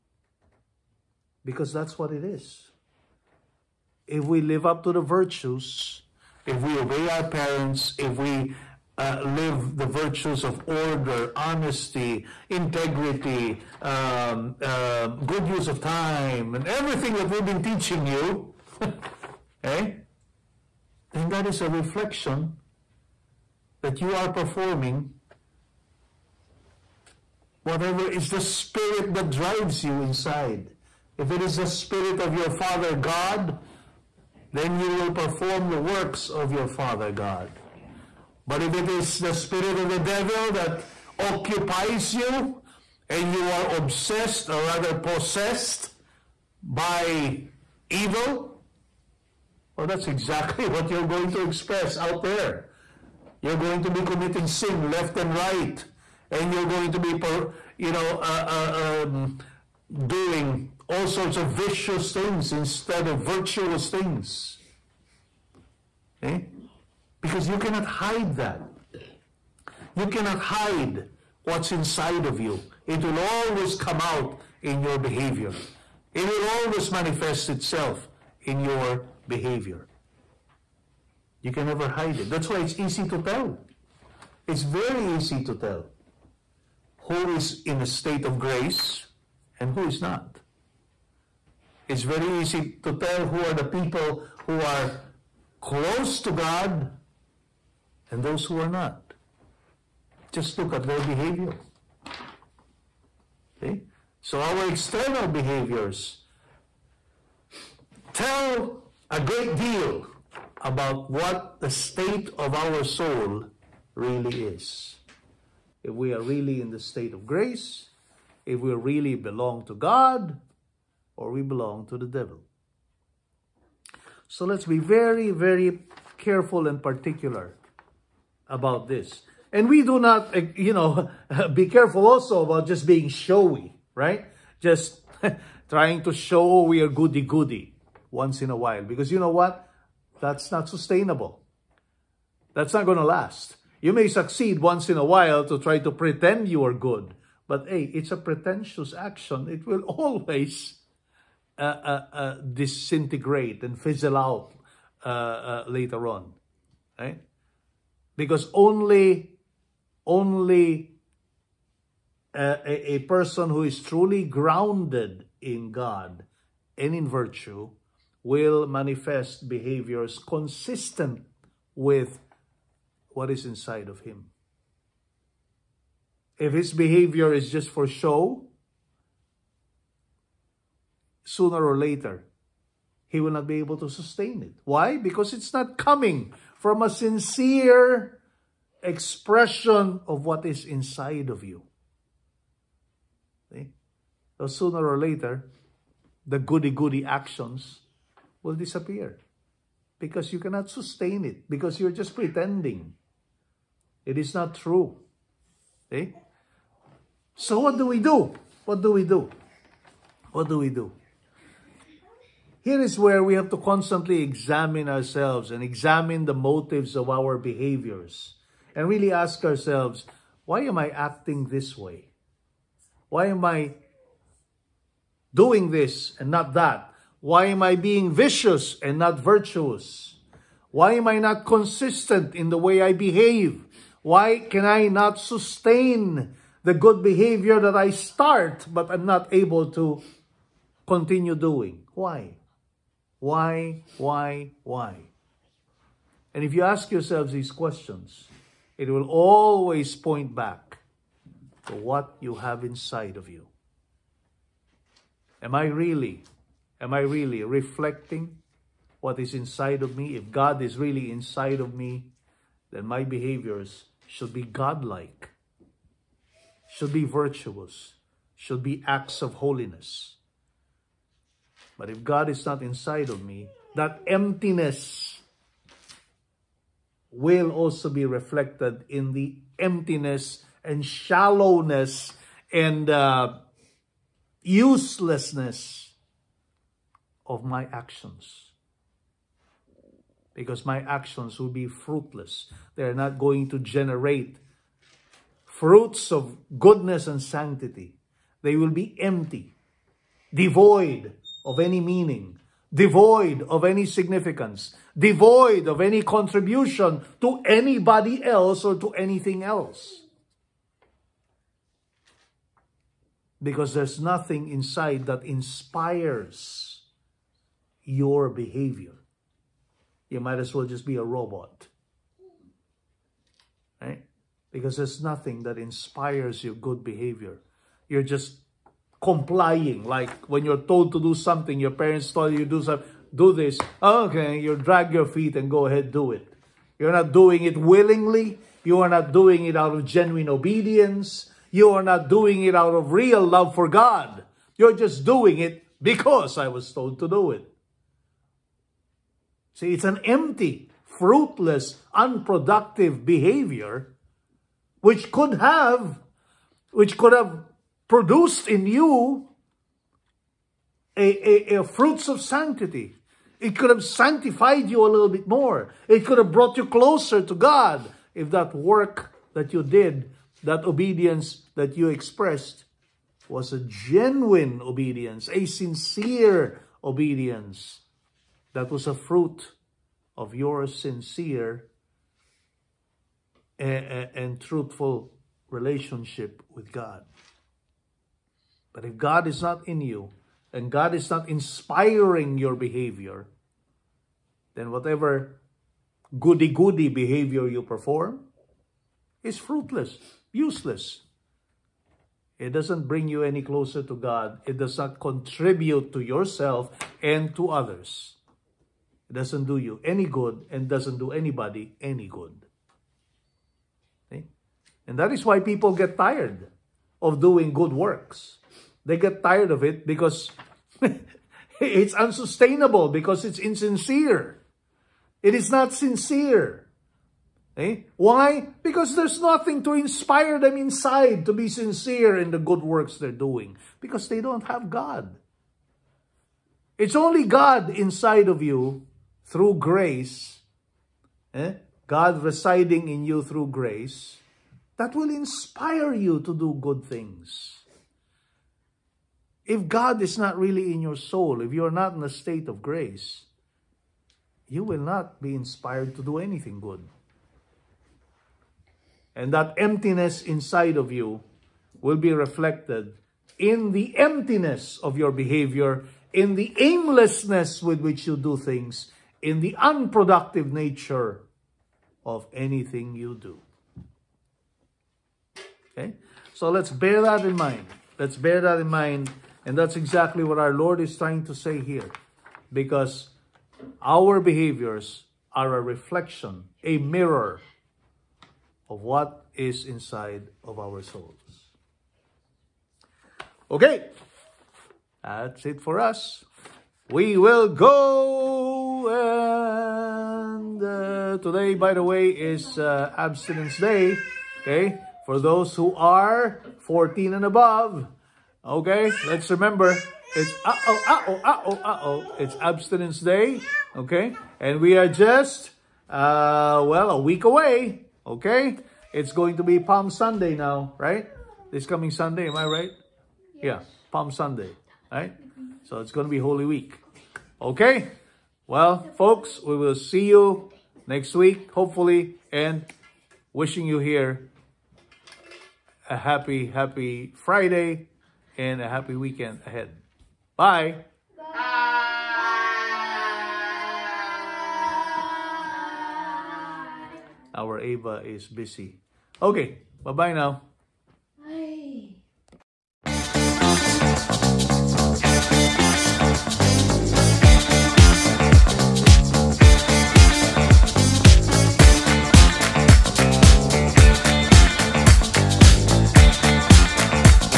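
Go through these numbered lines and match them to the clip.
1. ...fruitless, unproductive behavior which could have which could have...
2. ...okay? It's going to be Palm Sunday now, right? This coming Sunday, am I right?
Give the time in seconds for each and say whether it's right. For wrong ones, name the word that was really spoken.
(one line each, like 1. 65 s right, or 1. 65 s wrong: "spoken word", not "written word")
1. 350 s right
2. 518 s right.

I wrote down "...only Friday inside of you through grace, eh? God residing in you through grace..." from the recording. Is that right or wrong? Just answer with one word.
wrong.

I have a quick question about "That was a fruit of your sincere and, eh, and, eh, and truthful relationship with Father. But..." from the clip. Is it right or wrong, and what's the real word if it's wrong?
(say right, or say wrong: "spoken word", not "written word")
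wrong: "God", not "Father".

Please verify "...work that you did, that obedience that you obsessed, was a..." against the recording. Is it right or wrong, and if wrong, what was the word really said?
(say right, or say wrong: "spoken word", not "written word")
wrong: "expressed", not "obsessed".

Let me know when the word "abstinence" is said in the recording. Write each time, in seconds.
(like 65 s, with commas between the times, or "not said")
502 s, 512 s.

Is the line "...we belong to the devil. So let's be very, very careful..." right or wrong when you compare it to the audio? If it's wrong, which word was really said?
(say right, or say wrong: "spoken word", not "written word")
right.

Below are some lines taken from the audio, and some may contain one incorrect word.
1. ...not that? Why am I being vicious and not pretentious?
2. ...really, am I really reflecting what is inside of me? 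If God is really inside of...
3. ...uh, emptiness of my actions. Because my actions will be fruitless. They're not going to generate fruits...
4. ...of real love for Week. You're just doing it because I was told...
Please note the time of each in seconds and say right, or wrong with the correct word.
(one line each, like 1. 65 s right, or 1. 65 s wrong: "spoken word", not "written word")
1. 226 s wrong: "virtuous", not "pretentious"
2. 255 s right
3. 282 s wrong: "uselessness", not "emptiness"
4. 342 s wrong: "God", not "Week".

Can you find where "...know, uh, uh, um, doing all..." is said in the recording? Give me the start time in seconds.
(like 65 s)
57 s.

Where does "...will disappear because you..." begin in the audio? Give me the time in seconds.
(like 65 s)
198 s.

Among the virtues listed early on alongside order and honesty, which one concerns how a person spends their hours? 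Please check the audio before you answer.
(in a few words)
Good use of time.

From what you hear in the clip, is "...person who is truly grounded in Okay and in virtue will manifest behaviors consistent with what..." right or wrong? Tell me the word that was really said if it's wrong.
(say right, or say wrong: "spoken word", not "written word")
wrong: "God", not "Okay".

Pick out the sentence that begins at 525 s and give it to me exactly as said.
So it's going to be Holy Week, okay?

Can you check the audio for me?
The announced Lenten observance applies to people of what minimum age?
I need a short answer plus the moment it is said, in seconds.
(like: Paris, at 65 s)
14, at 506 s.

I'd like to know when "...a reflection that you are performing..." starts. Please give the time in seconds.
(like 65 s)
21 s.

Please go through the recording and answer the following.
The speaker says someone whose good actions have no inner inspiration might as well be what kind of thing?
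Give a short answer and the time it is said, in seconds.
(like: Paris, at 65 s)
A robot, at 320 s.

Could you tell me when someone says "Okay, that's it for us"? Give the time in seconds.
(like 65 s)
493 s.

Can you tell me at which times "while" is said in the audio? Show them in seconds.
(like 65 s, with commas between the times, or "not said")
138 s, 145 s.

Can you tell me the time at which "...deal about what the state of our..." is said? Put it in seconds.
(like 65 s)
109 s.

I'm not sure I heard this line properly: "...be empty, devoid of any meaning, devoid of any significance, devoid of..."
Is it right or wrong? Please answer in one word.
right.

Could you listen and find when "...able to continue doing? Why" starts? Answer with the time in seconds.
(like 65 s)
239 s.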